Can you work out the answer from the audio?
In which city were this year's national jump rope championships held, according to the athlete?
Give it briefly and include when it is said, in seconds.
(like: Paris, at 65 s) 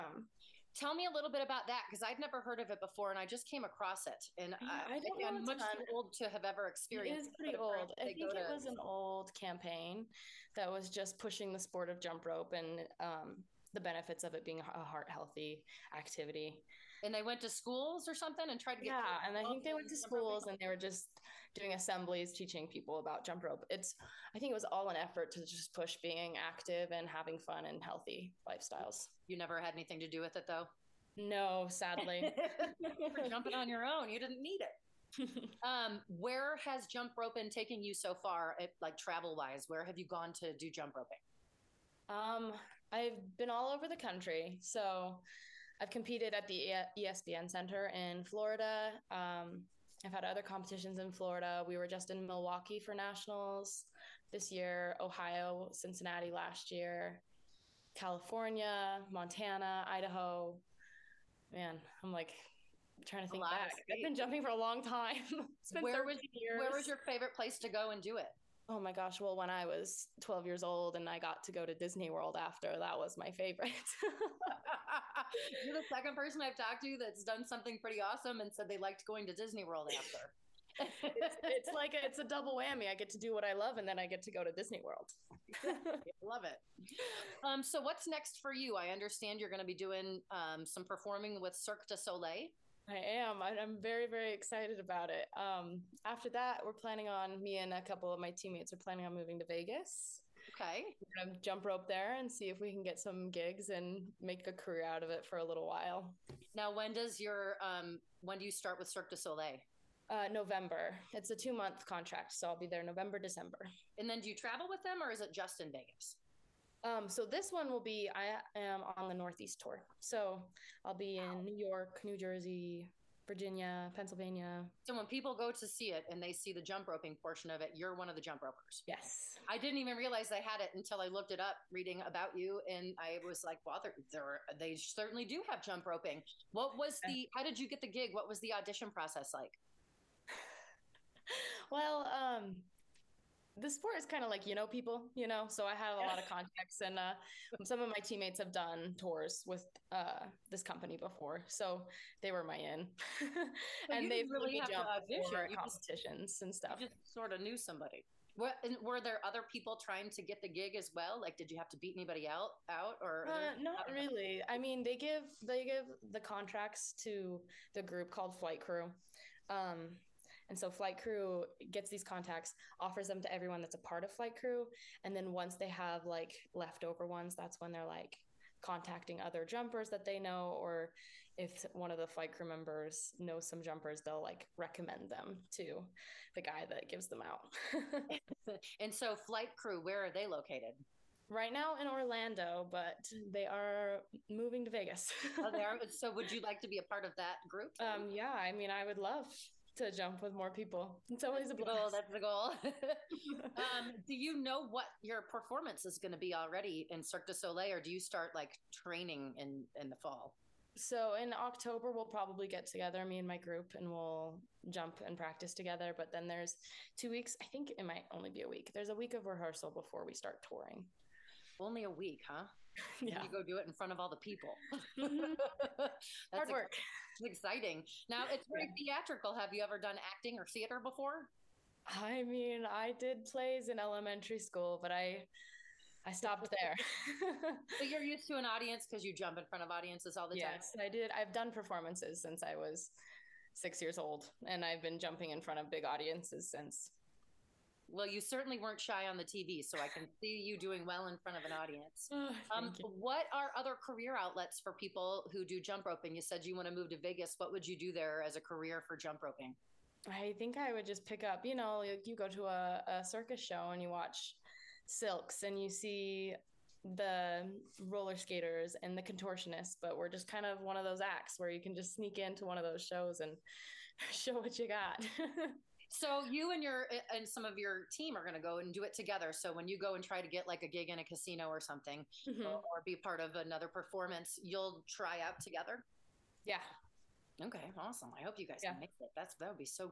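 Milwaukee, at 52 s.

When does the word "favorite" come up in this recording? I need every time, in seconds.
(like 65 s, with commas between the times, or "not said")
66 s, 73 s.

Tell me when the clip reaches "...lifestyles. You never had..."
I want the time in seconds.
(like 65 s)
28 s.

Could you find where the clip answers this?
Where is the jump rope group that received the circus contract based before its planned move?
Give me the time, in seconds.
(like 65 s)
191 s.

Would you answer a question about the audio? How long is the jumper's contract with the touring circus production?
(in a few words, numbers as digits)
2 months.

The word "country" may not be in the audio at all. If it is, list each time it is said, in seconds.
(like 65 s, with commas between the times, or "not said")
43 s.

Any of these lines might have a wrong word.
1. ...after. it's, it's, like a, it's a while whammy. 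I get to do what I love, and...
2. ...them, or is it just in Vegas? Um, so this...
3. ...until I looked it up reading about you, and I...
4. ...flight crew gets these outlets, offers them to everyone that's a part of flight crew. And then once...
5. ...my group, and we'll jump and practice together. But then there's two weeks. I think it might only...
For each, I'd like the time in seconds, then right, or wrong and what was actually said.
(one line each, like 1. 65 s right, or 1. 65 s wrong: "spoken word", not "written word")
1. 79 s wrong: "double", not "while"
2. 114 s right
3. 130 s right
4. 170 s wrong: "contacts", not "outlets"
5. 213 s right.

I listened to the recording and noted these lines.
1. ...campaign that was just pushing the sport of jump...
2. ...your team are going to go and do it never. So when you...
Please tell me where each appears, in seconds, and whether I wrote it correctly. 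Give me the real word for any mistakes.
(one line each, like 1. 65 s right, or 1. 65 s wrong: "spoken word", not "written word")
1. 9 s right
2. 277 s wrong: "together", not "never".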